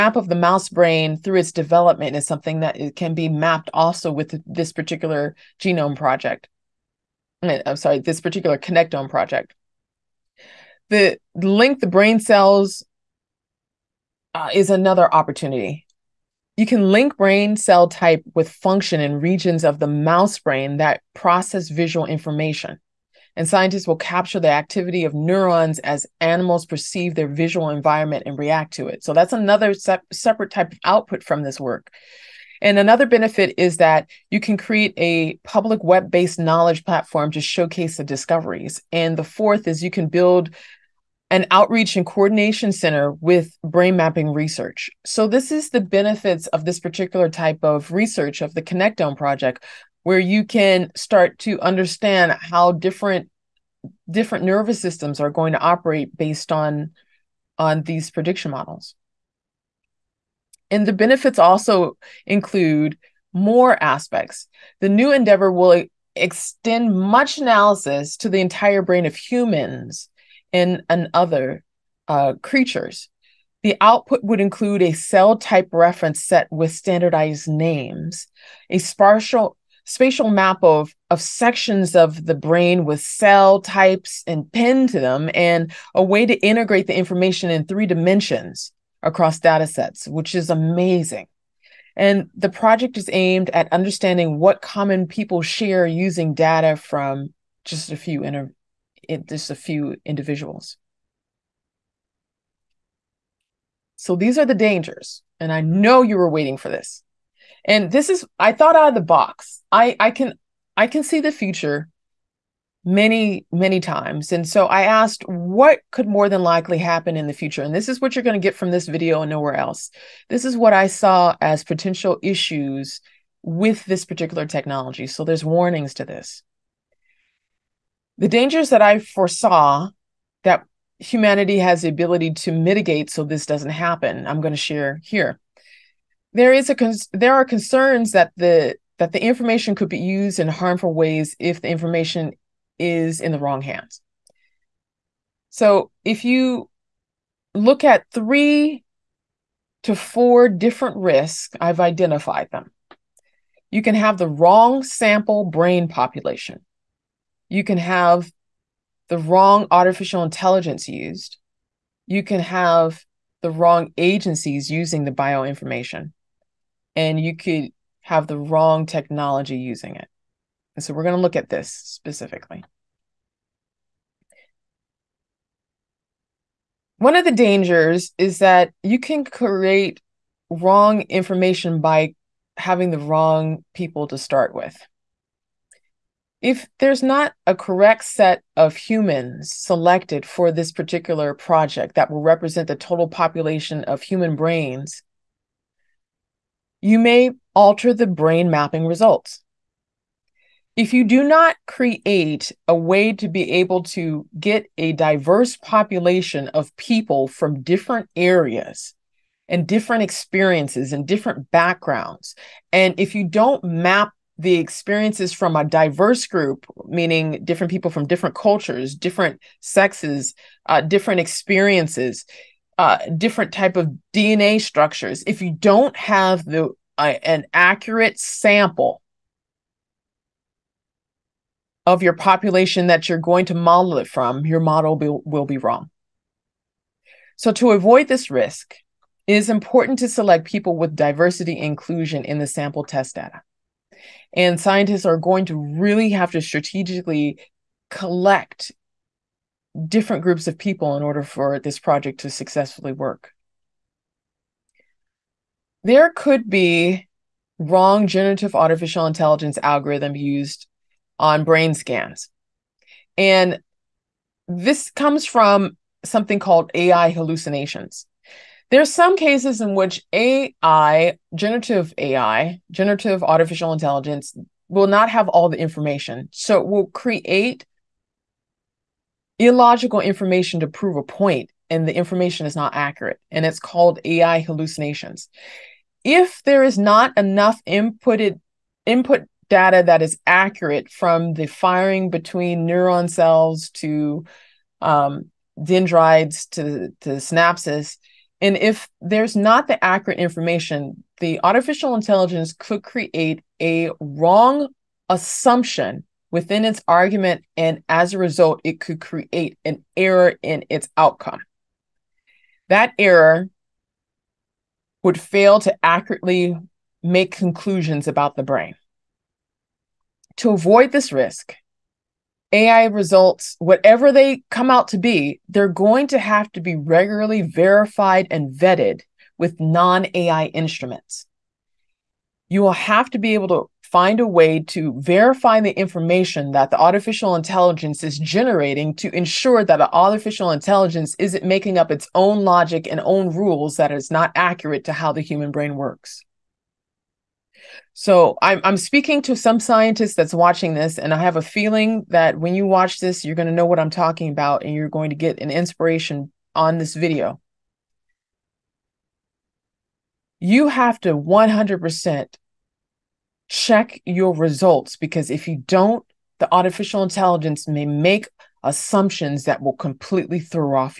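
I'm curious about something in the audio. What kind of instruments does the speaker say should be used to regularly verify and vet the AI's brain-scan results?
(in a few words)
non AI instruments.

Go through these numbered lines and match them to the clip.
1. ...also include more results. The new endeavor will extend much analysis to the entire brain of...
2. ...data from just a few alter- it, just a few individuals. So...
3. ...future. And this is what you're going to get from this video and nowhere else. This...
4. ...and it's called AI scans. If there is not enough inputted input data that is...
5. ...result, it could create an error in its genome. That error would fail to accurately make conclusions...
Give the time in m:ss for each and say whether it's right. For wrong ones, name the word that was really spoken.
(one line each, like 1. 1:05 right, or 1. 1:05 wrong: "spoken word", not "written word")
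1. 1:01 wrong: "aspects", not "results"
2. 1:36 wrong: "inter", not "alter"
3. 1:57 right
4. 4:43 wrong: "hallucinations", not "scans"
5. 5:08 wrong: "outcome", not "genome".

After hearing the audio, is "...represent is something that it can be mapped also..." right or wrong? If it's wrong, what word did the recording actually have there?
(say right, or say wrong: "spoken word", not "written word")
wrong: "development", not "represent".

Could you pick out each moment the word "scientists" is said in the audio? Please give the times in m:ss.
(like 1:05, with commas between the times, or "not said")
0:23, 4:04, 5:49.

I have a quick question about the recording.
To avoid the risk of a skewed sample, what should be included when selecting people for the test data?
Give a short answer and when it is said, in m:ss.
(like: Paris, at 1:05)
diversity inclusion, at 4:00.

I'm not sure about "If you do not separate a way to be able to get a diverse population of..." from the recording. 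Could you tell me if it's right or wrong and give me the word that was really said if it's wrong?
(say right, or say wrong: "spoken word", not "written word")
wrong: "create", not "separate".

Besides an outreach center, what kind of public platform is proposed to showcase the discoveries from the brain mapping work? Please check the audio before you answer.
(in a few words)
web based knowledge platform.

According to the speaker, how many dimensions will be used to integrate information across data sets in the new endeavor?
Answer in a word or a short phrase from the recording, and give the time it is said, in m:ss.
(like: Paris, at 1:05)
3, at 1:27.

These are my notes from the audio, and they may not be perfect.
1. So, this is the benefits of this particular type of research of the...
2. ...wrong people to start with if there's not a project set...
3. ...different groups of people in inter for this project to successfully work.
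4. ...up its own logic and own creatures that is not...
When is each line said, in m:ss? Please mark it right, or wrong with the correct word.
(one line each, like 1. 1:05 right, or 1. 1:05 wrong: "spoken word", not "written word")
1. 0:45 right
2. 3:02 wrong: "correct", not "project"
3. 4:09 wrong: "order", not "inter"
4. 5:41 wrong: "rules", not "creatures".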